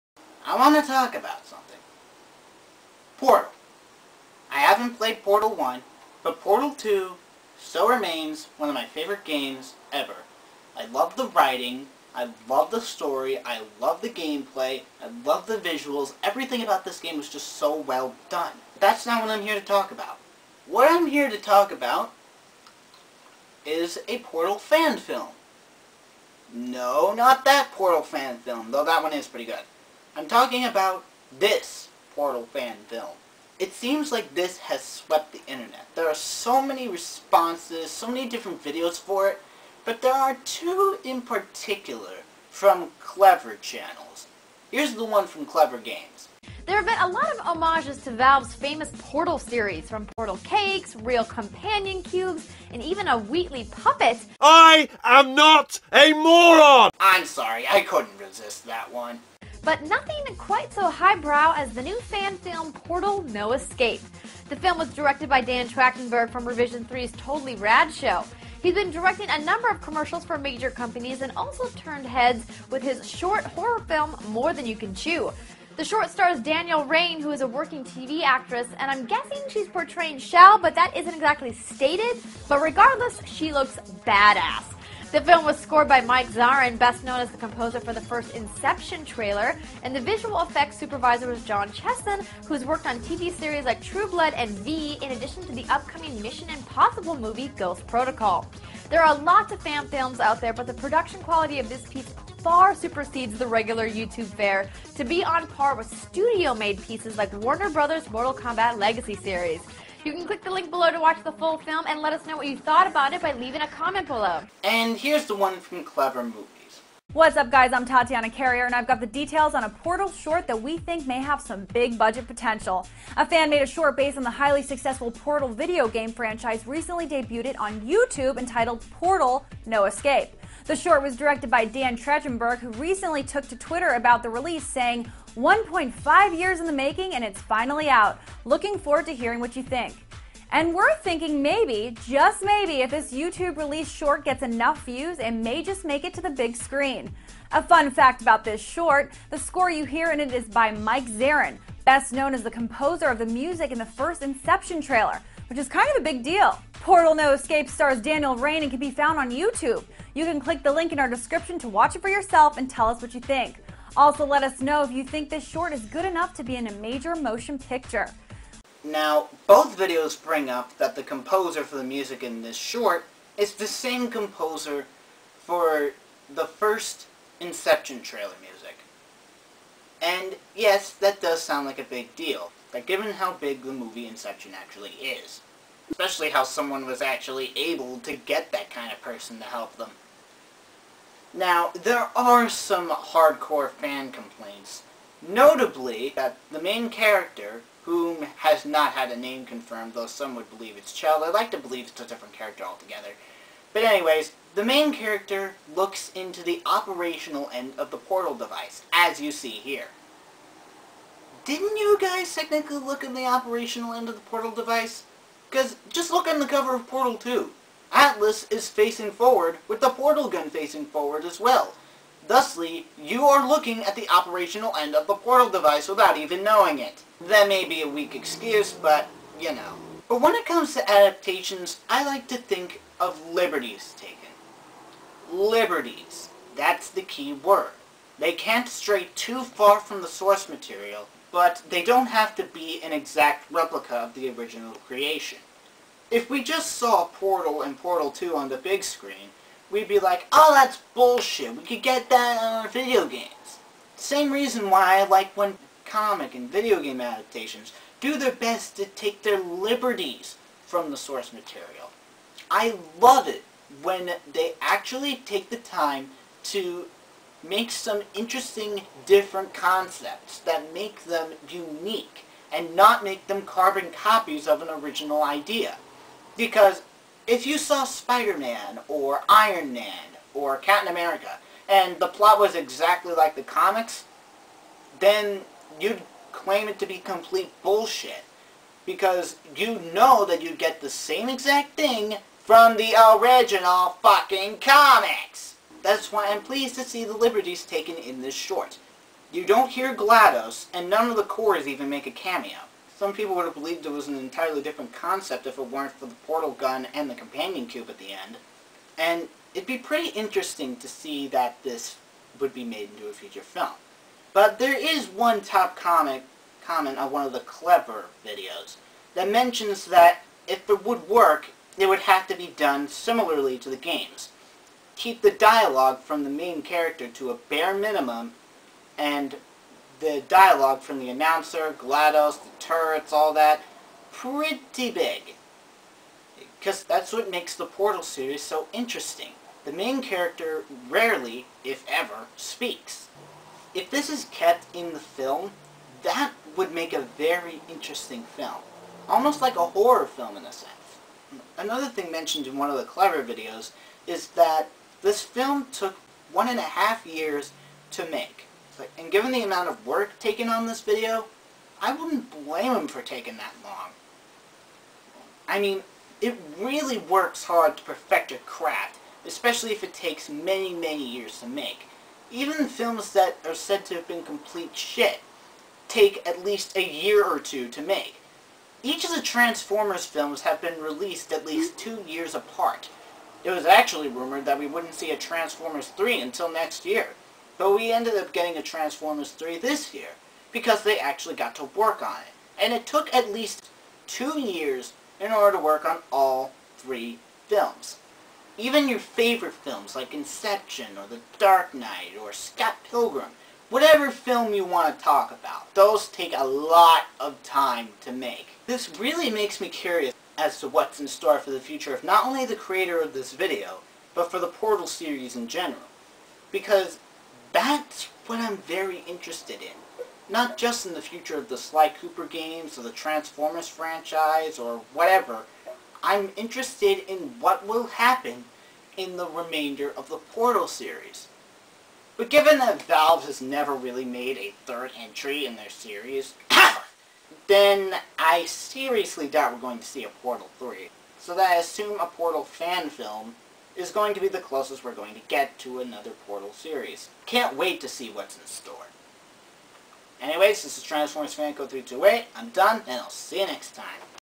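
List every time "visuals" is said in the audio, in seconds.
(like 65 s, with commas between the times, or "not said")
15 s, 89 s.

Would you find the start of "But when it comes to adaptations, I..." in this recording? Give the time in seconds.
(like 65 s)
230 s.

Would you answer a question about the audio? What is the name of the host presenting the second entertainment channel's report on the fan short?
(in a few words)
Tatiana Carrier.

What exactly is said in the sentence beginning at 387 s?
But we ended up getting a Transformers 3 this year, because they actually got to work on it.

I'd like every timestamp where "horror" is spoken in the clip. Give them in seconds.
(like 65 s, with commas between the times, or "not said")
73 s, 349 s.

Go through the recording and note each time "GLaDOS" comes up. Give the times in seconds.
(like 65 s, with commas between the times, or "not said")
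299 s, 331 s.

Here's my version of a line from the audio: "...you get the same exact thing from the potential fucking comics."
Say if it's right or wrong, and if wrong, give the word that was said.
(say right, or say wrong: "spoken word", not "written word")
wrong: "original", not "potential".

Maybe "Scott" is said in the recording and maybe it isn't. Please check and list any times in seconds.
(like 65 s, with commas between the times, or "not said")
402 s.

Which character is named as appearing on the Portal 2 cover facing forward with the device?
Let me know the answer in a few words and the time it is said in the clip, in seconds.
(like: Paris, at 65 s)
Atlas, at 217 s.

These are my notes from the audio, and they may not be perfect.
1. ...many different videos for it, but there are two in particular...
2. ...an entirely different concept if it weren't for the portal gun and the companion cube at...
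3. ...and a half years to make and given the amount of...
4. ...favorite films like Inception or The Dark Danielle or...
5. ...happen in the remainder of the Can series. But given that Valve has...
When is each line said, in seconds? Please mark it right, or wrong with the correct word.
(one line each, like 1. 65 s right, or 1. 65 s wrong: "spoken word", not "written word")
1. 38 s right
2. 304 s right
3. 356 s right
4. 398 s wrong: "Knight", not "Danielle"
5. 427 s wrong: "Portal", not "Can".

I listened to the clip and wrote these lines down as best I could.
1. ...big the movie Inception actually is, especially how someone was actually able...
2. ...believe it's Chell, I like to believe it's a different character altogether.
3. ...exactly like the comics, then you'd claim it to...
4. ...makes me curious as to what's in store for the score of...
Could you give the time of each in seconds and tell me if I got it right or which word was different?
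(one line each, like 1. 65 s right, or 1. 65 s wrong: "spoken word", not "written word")
1. 183 s right
2. 200 s right
3. 282 s right
4. 409 s wrong: "future", not "score".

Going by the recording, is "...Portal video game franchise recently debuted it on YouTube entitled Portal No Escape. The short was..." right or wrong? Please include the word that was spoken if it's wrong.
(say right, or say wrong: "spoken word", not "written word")
right.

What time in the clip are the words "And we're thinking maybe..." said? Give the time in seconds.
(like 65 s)
140 s.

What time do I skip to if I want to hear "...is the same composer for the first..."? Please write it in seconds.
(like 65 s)
173 s.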